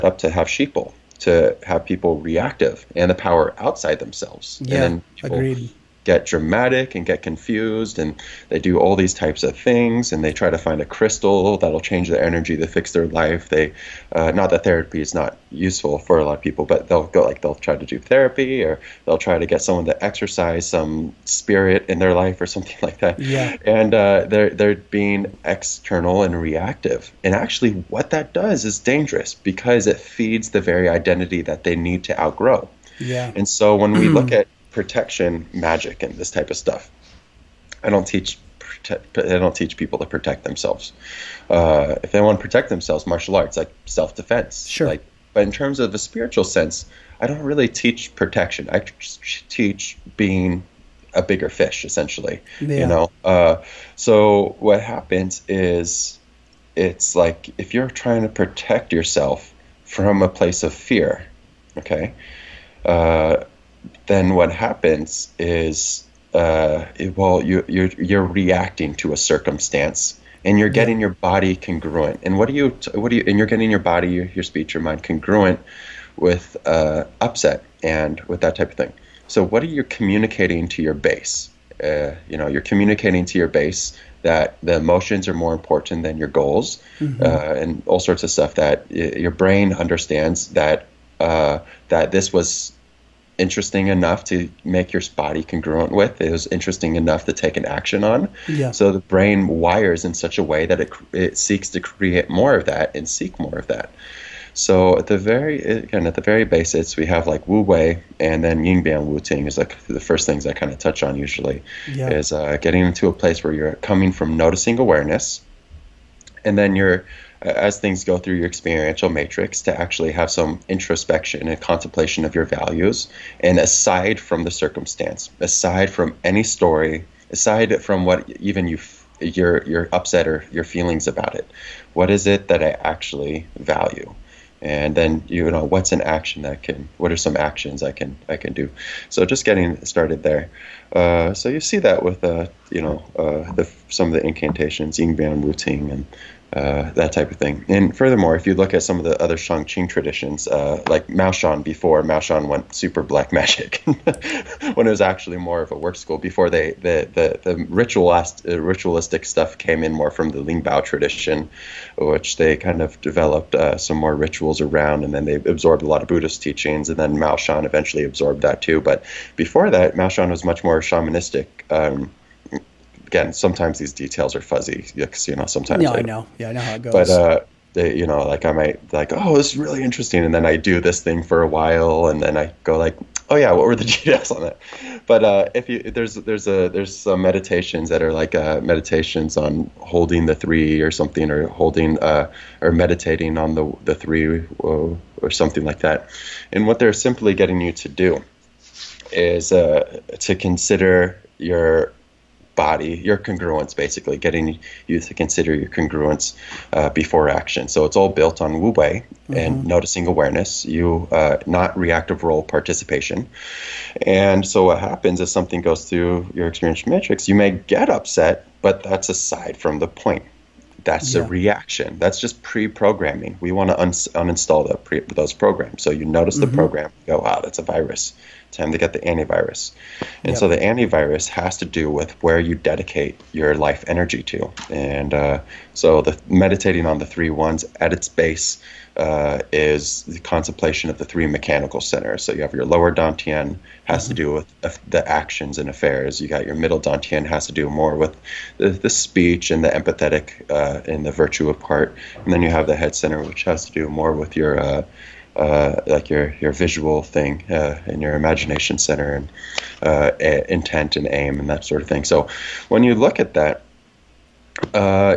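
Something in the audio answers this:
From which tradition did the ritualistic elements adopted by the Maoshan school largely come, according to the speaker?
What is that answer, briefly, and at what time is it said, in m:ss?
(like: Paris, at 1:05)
Lingbao, at 2:40.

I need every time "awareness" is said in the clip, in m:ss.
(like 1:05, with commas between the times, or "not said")
1:54, 3:30.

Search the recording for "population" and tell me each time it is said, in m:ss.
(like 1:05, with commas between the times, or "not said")
not said.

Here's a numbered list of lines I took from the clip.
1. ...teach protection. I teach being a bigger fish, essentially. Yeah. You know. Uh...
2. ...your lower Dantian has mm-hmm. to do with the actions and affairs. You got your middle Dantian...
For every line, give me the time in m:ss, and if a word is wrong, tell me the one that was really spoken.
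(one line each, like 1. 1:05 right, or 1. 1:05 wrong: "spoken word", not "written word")
1. 0:47 right
2. 4:02 right.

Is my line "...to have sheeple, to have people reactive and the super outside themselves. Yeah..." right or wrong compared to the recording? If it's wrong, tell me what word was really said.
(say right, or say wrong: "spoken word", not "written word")
wrong: "power", not "super".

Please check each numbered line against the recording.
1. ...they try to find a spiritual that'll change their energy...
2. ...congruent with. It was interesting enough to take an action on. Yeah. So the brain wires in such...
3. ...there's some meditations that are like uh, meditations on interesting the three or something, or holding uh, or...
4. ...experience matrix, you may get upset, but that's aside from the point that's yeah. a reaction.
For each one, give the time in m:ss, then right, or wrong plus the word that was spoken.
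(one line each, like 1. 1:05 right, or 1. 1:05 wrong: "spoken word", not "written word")
1. 0:10 wrong: "crystal", not "spiritual"
2. 1:35 right
3. 3:06 wrong: "holding", not "interesting"
4. 3:36 right.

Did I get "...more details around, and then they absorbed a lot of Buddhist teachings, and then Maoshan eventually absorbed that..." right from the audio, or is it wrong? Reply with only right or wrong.
wrong.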